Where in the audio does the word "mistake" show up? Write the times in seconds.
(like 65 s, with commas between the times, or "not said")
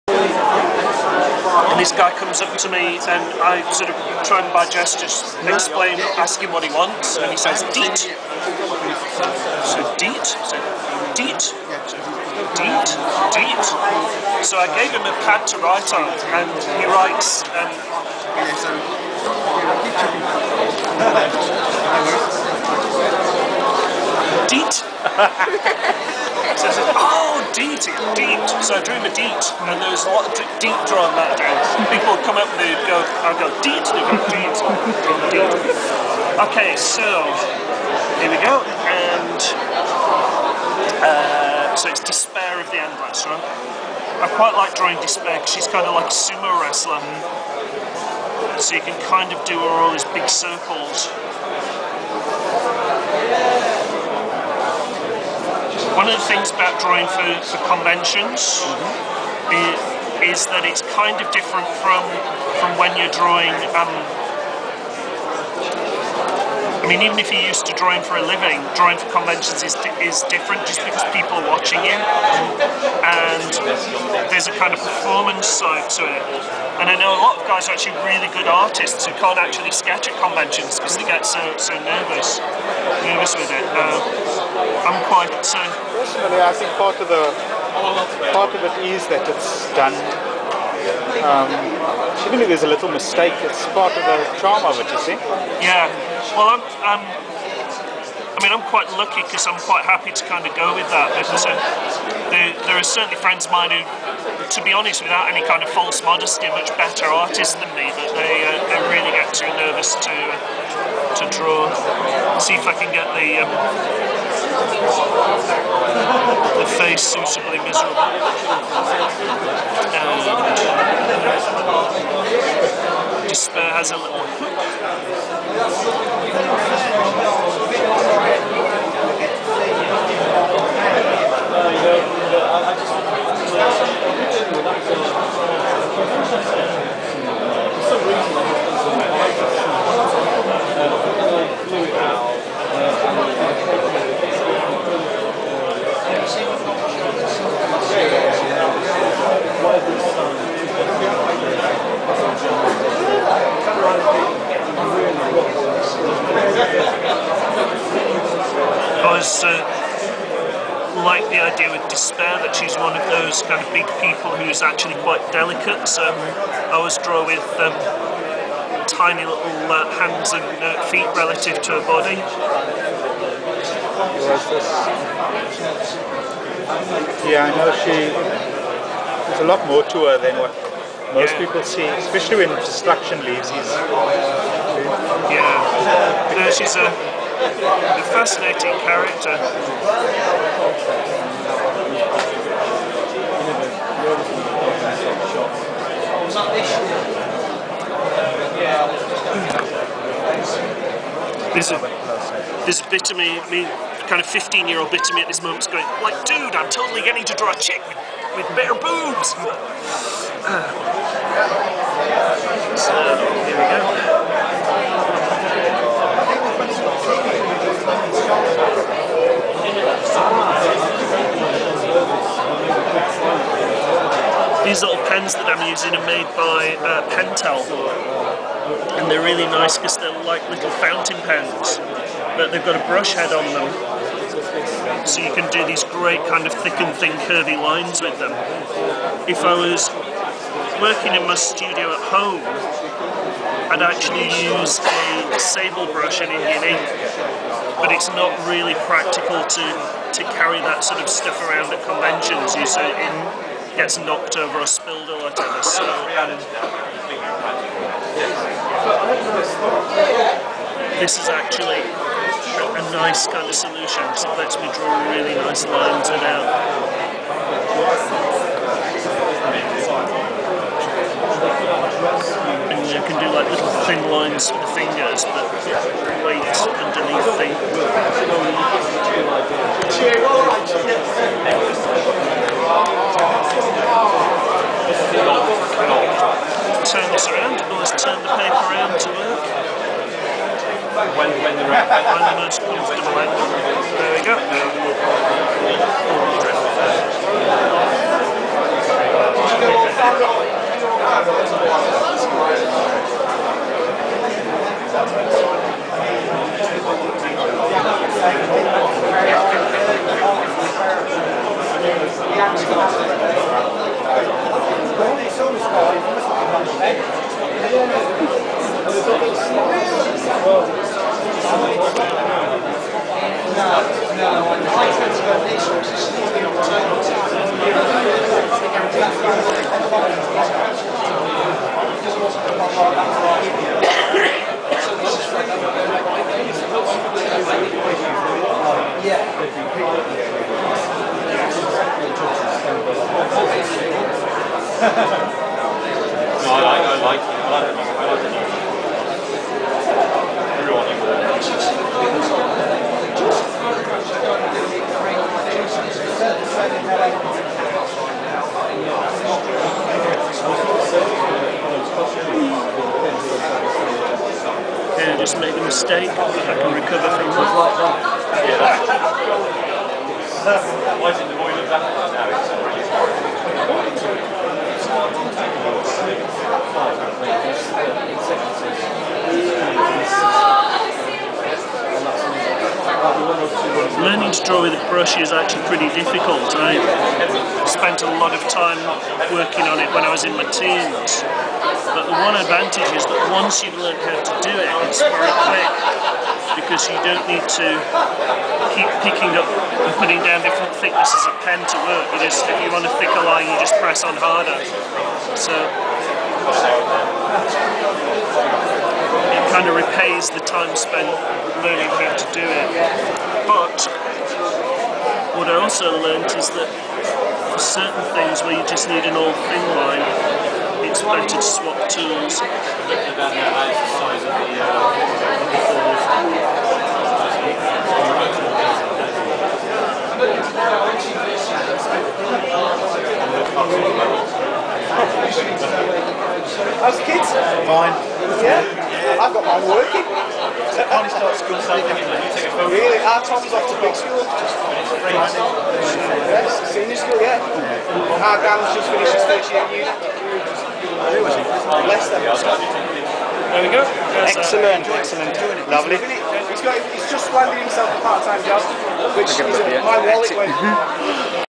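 92 s, 365 s.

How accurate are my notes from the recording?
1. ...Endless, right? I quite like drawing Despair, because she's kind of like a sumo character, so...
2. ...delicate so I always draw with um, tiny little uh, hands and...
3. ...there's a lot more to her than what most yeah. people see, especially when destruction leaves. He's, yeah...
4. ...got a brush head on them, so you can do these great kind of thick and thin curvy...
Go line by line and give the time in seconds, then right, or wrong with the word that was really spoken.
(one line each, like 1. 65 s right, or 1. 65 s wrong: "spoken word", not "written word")
1. 42 s wrong: "wrestler", not "character"
2. 165 s right
3. 178 s right
4. 232 s right.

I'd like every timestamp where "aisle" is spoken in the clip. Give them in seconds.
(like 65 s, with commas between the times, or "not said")
not said.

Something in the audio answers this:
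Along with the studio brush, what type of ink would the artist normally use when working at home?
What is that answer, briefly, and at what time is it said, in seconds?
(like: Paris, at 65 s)
Indian ink, at 246 s.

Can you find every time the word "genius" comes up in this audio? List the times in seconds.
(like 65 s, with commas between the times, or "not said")
not said.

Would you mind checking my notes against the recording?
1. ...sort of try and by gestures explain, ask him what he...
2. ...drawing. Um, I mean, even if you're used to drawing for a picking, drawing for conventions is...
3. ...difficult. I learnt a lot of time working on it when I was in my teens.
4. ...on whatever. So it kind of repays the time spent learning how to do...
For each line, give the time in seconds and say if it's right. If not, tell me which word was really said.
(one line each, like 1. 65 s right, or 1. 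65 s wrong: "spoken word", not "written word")
1. 3 s right
2. 63 s wrong: "living", not "picking"
3. 385 s wrong: "spent", not "learnt"
4. 404 s wrong: "harder", not "whatever".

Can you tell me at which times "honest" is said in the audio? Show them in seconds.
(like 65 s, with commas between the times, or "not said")
104 s.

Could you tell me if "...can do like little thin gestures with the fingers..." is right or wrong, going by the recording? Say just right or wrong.
wrong.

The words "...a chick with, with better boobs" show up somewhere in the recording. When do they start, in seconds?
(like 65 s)
207 s.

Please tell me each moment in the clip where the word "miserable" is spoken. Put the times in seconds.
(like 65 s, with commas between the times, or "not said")
116 s.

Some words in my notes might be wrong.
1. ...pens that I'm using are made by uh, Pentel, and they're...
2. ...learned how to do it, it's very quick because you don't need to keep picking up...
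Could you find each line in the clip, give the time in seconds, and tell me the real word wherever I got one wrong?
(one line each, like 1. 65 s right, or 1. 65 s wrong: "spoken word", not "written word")
1. 225 s right
2. 393 s right.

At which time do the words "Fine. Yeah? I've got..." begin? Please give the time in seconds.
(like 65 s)
437 s.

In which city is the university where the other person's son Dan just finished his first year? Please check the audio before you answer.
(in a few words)
Leicester.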